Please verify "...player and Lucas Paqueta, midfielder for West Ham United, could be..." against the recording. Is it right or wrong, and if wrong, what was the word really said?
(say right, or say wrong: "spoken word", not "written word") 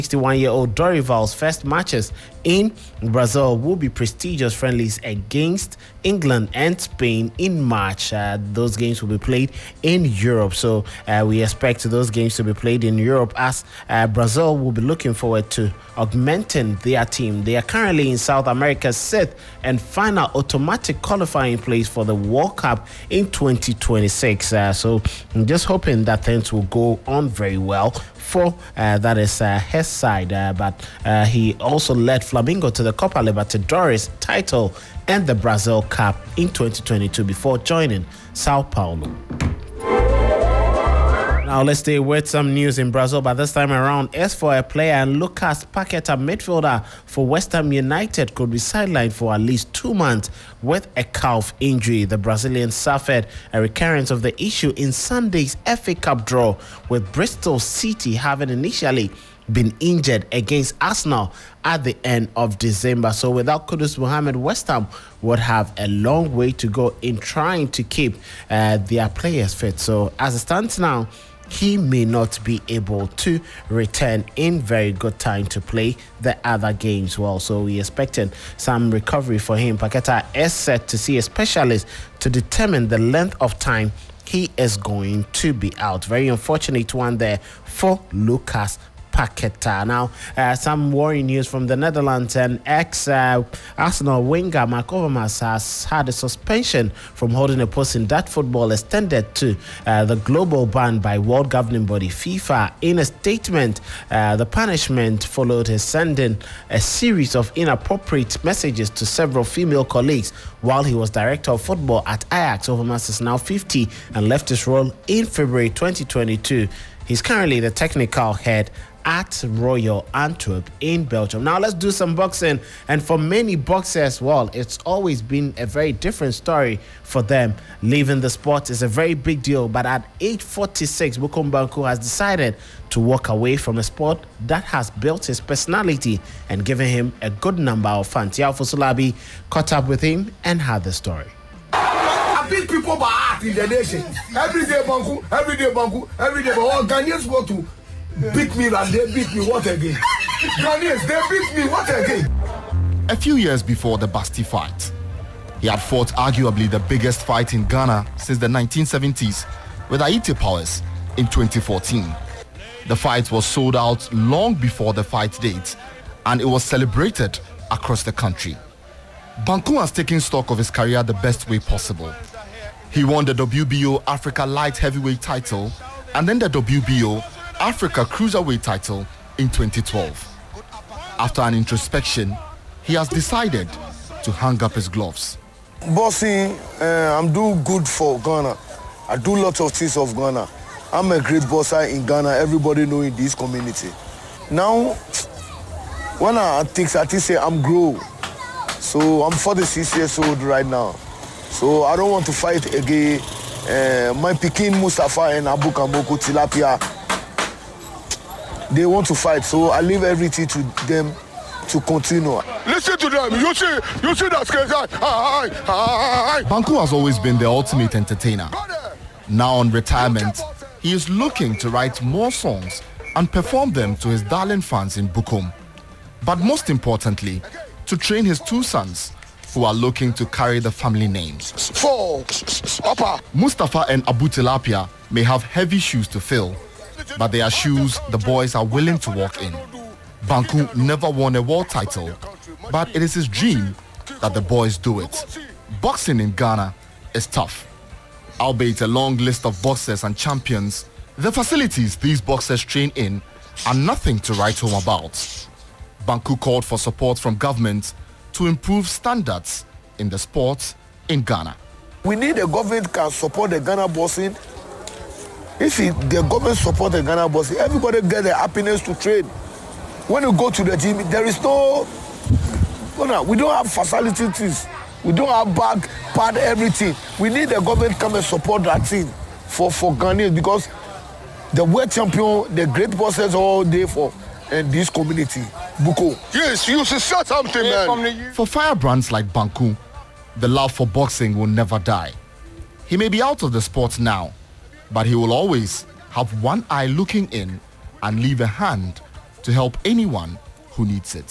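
right.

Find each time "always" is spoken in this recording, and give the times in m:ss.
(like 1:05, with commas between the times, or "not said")
2:04, 3:36, 4:55.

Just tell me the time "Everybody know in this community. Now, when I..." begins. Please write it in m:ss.
3:12.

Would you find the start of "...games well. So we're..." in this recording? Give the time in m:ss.
1:16.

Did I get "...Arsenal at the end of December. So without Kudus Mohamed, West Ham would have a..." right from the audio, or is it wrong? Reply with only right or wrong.
right.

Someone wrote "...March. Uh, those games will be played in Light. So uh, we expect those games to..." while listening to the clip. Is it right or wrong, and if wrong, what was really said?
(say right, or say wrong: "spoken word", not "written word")
wrong: "Europe", not "Light".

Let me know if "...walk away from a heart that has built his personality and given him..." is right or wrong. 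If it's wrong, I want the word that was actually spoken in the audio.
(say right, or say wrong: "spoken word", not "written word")
wrong: "sport", not "heart".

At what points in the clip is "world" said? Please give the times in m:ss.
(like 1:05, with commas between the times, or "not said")
0:22, 1:41, 4:01, 4:41.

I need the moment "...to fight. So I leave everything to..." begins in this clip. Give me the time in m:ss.
3:29.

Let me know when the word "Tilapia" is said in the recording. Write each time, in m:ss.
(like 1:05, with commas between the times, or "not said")
3:26, 3:54.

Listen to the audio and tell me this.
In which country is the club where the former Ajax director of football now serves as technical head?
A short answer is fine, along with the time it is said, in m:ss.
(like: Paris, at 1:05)
Belgium, at 2:01.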